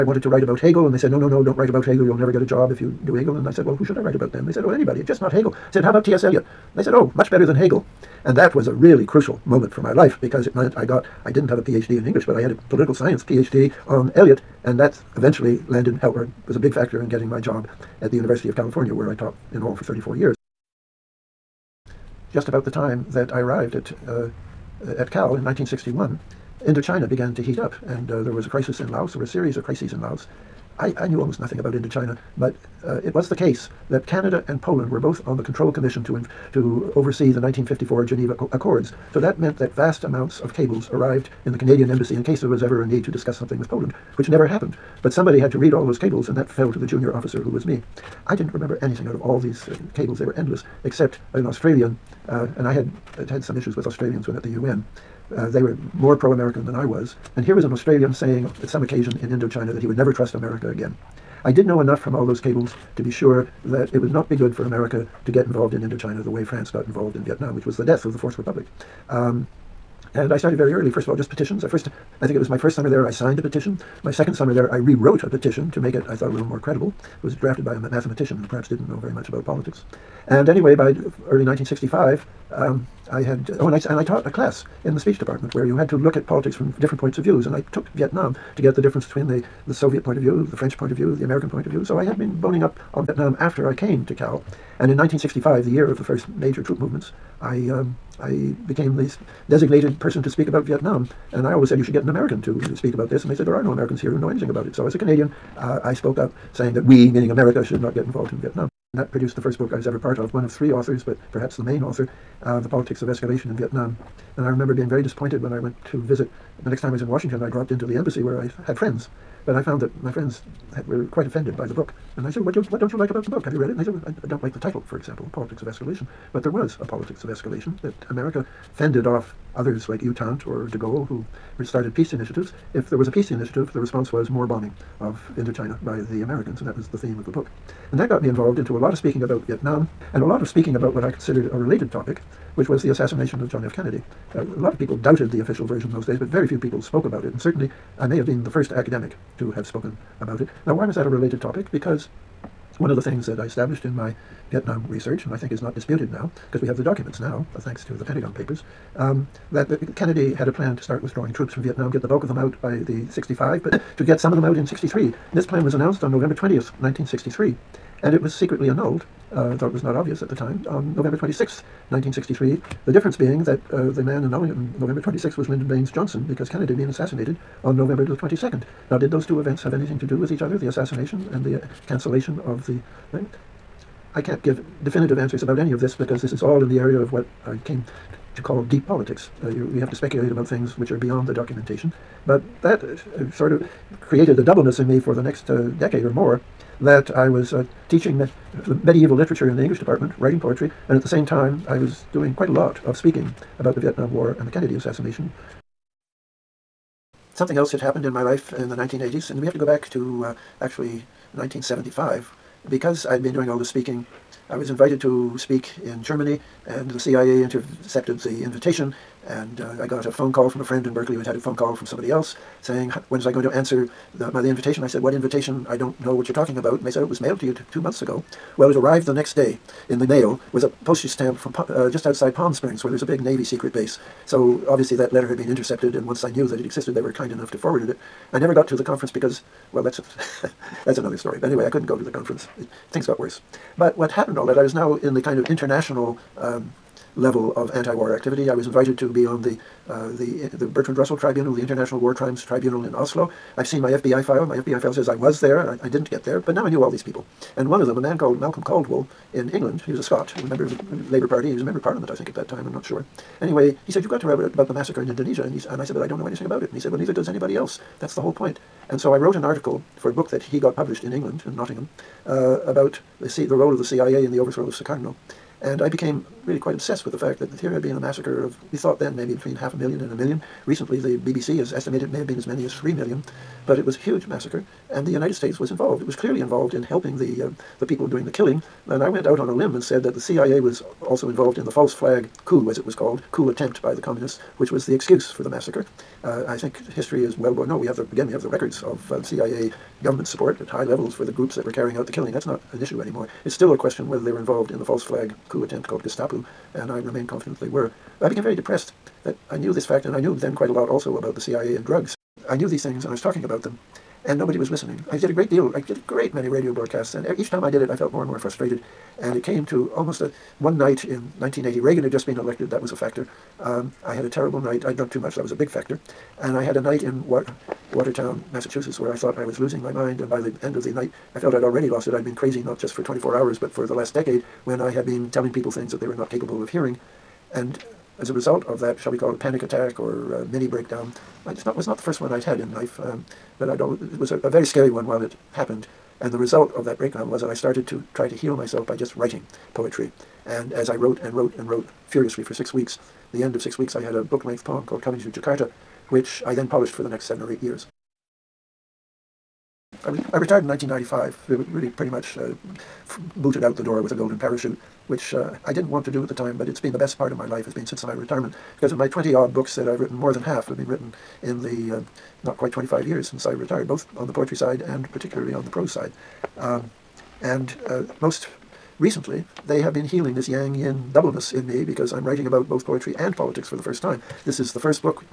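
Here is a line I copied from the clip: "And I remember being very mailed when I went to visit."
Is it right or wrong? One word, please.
wrong.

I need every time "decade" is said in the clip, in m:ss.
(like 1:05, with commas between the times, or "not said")
3:15, 5:34.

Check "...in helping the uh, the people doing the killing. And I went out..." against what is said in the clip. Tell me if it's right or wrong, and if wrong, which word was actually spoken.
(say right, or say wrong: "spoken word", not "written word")
right.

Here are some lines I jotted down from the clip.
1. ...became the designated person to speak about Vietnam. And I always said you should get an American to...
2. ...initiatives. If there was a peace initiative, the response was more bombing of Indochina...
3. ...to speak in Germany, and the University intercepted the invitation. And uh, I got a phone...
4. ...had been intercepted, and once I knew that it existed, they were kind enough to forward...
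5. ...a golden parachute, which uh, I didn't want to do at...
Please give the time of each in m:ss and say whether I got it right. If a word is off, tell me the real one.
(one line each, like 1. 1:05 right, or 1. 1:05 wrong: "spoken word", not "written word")
1. 1:38 right
2. 2:12 right
3. 3:35 wrong: "CIA", not "University"
4. 3:55 right
5. 6:04 right.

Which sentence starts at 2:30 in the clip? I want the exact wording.
Now, why was that a related topic?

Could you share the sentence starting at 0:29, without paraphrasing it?
There were a series of crises in Laos.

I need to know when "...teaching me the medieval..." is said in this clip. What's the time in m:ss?
3:17.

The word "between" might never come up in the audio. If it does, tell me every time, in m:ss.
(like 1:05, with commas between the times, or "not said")
1:29, 4:39.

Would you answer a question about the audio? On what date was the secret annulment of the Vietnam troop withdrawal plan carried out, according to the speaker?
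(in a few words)
November 26th, 1963.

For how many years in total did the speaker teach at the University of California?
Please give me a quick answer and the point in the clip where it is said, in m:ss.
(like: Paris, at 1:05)
34 years, at 0:19.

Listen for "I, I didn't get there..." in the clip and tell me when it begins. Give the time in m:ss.
4:15.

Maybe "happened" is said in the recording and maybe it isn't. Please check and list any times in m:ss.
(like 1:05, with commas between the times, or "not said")
0:44, 3:27, 4:04, 5:45.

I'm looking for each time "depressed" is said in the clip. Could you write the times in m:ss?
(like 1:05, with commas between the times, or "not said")
5:08.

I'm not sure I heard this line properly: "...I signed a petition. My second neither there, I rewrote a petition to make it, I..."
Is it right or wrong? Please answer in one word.
wrong.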